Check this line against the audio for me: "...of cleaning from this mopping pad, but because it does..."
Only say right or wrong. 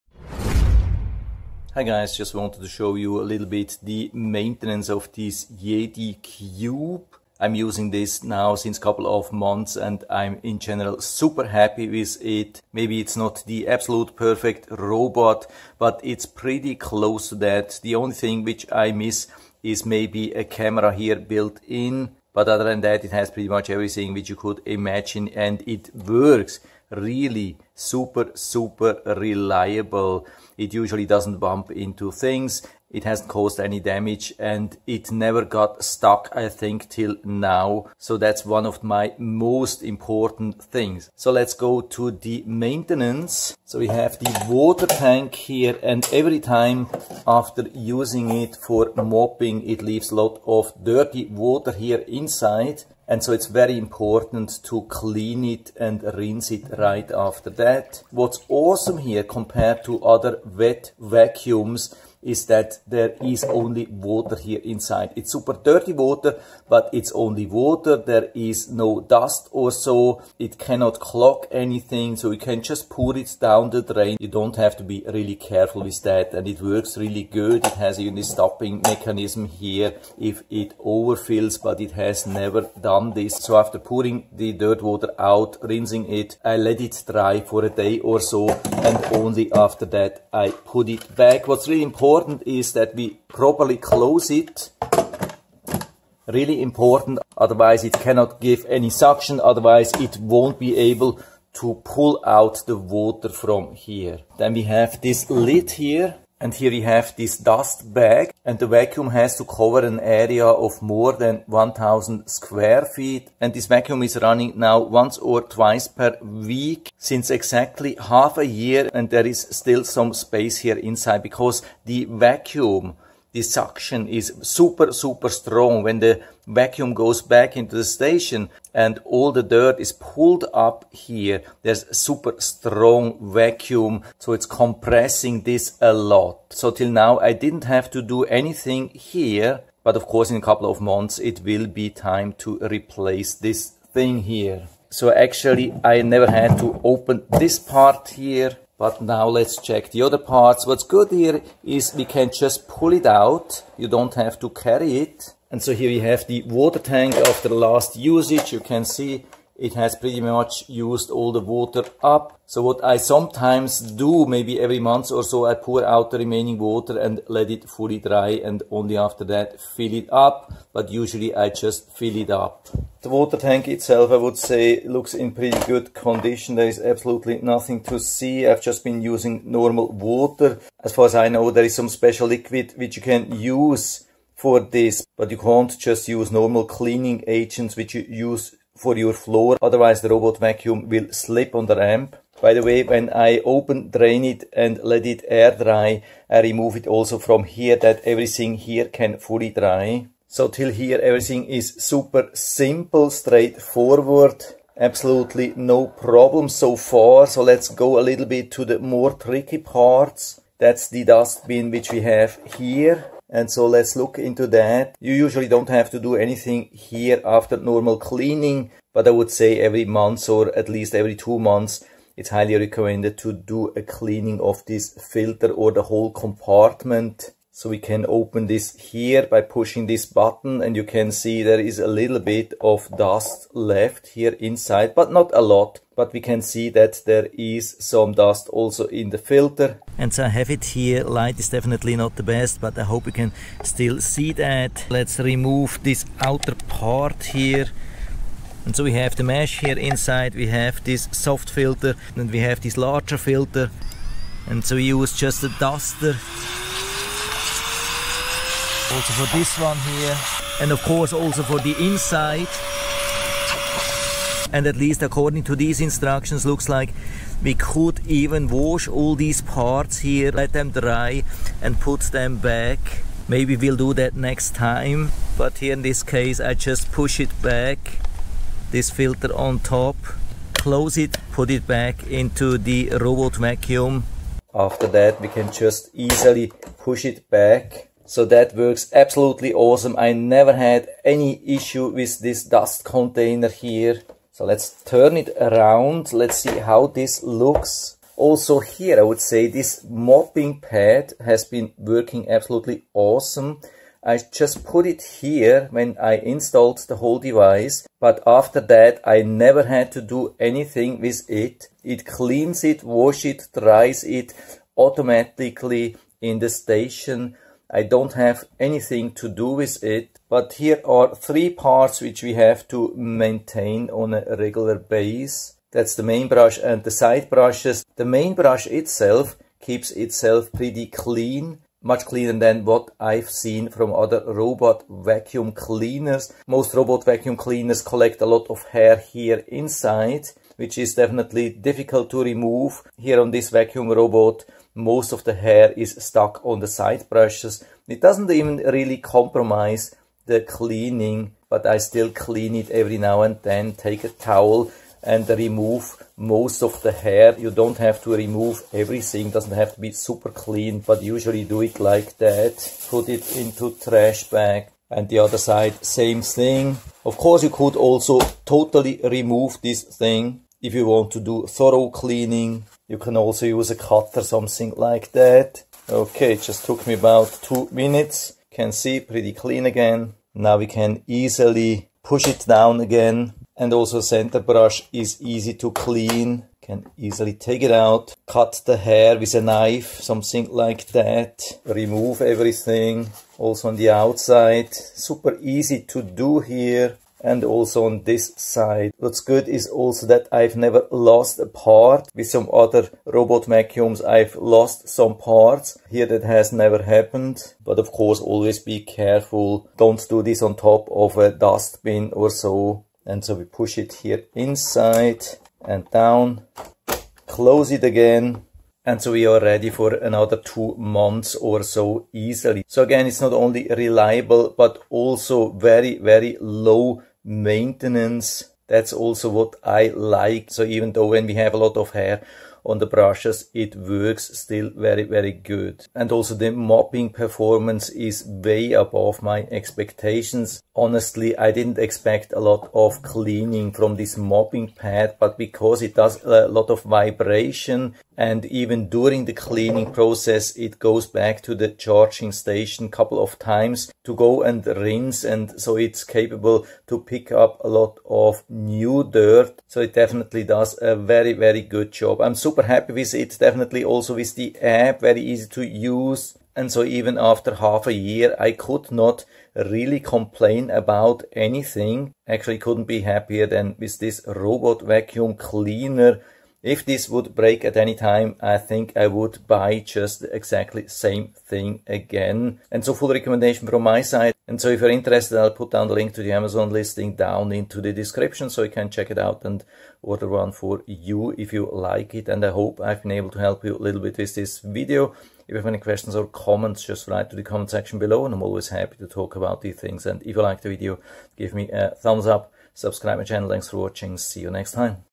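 right.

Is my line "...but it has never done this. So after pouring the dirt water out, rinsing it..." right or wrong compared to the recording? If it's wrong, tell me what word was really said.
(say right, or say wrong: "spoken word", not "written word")
right.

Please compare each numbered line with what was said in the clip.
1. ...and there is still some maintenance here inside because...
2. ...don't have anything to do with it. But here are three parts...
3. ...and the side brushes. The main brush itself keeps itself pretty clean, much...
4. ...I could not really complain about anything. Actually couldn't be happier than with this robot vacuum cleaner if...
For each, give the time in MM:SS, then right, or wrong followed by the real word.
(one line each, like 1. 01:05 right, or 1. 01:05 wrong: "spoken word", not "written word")
1. 01:58 wrong: "space", not "maintenance"
2. 05:17 right
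3. 05:26 right
4. 07:48 right.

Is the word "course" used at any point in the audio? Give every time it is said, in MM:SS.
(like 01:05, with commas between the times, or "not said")
02:20, 04:20, 06:07, 06:47.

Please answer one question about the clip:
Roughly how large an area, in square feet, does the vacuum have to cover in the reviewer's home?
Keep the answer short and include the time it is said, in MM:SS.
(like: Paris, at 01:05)
More than 1000 square feet, at 01:50.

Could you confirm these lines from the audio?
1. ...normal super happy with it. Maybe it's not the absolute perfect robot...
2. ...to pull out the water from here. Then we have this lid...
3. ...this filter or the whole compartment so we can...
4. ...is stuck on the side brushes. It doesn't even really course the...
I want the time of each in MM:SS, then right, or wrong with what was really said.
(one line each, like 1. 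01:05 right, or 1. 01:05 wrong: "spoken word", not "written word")
1. 00:10 wrong: "general", not "normal"
2. 01:41 right
3. 03:44 right
4. 05:45 wrong: "compromise", not "course".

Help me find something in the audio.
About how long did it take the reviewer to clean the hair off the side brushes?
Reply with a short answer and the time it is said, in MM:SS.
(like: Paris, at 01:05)
About 2 minutes, at 06:16.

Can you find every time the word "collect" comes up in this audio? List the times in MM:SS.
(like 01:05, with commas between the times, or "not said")
05:37.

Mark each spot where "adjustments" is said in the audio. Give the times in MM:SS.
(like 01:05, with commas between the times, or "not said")
not said.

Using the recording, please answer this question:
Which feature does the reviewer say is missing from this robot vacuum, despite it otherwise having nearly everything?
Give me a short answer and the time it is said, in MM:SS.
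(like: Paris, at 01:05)
A camera, at 00:20.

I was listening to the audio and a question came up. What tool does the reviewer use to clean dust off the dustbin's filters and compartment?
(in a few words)
A duster.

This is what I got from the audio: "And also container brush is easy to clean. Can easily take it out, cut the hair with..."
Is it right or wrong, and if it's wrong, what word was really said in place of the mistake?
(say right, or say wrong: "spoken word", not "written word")
wrong: "center", not "container".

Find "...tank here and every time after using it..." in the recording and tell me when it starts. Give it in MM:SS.
00:44.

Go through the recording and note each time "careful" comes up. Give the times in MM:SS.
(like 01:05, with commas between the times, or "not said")
01:15, 06:48.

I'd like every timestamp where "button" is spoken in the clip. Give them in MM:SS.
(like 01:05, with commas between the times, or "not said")
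03:50.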